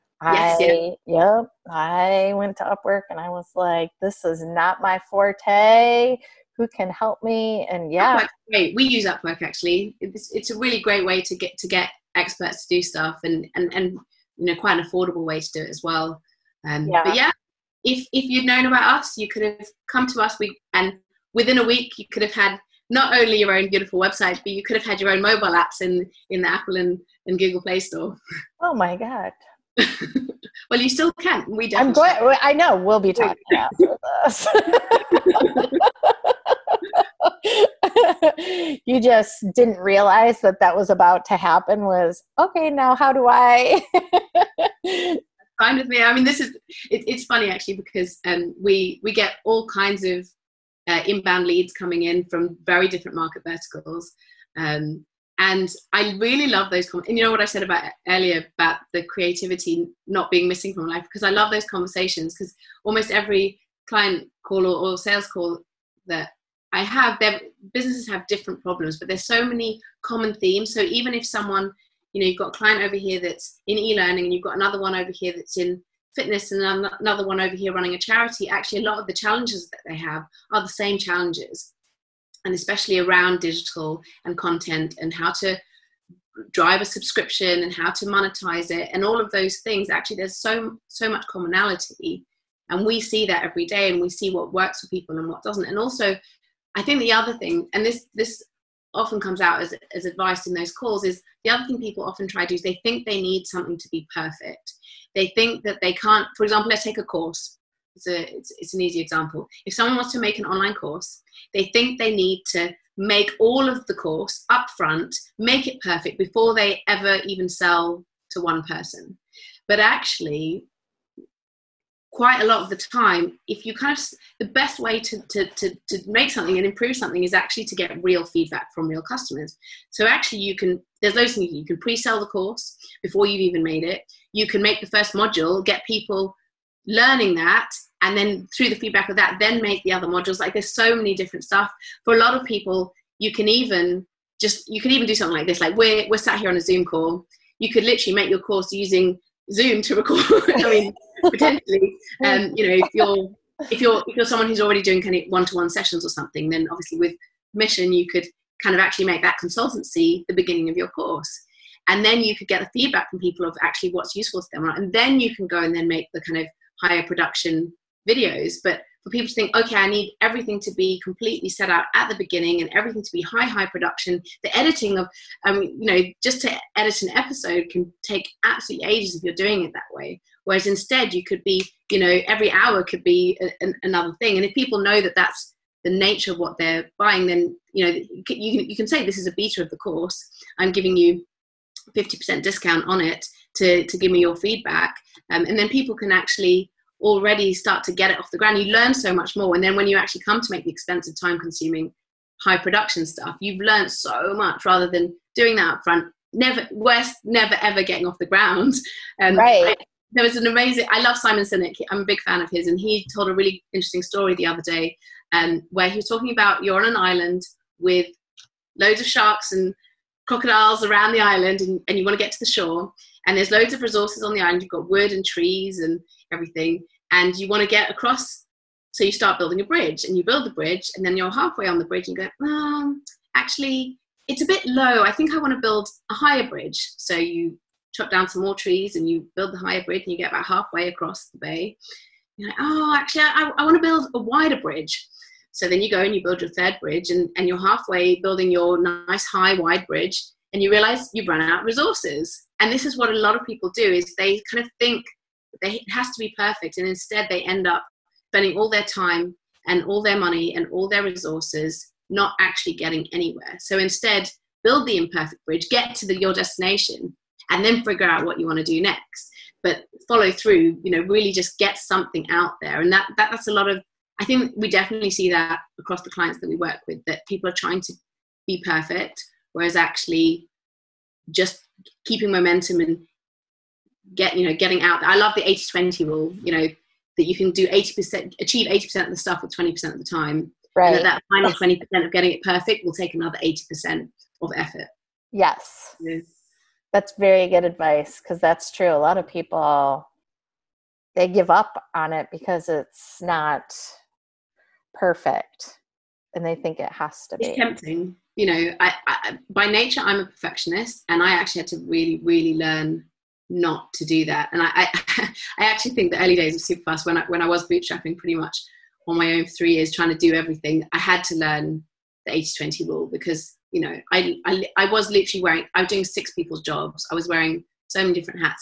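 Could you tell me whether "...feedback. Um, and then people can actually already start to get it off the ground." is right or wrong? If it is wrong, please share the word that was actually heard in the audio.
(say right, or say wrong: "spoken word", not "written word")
right.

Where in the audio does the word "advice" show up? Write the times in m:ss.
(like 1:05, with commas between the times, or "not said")
1:40, 4:57.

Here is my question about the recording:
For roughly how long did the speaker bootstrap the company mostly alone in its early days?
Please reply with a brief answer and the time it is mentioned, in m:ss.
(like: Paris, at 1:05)
3 years, at 5:19.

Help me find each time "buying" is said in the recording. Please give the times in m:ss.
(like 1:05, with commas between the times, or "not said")
3:06.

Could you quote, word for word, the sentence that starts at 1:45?
They think that they can't, for example, let's take a course.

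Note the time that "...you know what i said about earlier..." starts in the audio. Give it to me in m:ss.
0:57.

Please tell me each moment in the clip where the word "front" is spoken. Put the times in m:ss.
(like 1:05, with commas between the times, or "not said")
1:54, 3:25.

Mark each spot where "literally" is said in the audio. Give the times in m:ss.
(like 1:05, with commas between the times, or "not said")
2:27, 5:25.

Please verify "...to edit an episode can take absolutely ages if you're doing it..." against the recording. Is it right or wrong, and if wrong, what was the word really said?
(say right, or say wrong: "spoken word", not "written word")
right.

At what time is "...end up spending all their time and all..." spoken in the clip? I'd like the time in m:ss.
4:17.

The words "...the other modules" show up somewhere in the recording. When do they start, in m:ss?
2:19.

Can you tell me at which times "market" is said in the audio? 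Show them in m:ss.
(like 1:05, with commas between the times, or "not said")
0:53.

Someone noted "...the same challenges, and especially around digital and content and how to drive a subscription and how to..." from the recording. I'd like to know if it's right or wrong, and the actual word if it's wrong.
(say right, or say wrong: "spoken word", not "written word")
right.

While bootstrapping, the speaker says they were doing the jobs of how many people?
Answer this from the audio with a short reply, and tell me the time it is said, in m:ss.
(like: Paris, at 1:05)
6, at 5:26.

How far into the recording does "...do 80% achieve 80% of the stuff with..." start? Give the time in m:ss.
4:47.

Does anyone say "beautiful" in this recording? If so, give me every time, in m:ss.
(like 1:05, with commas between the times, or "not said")
0:23.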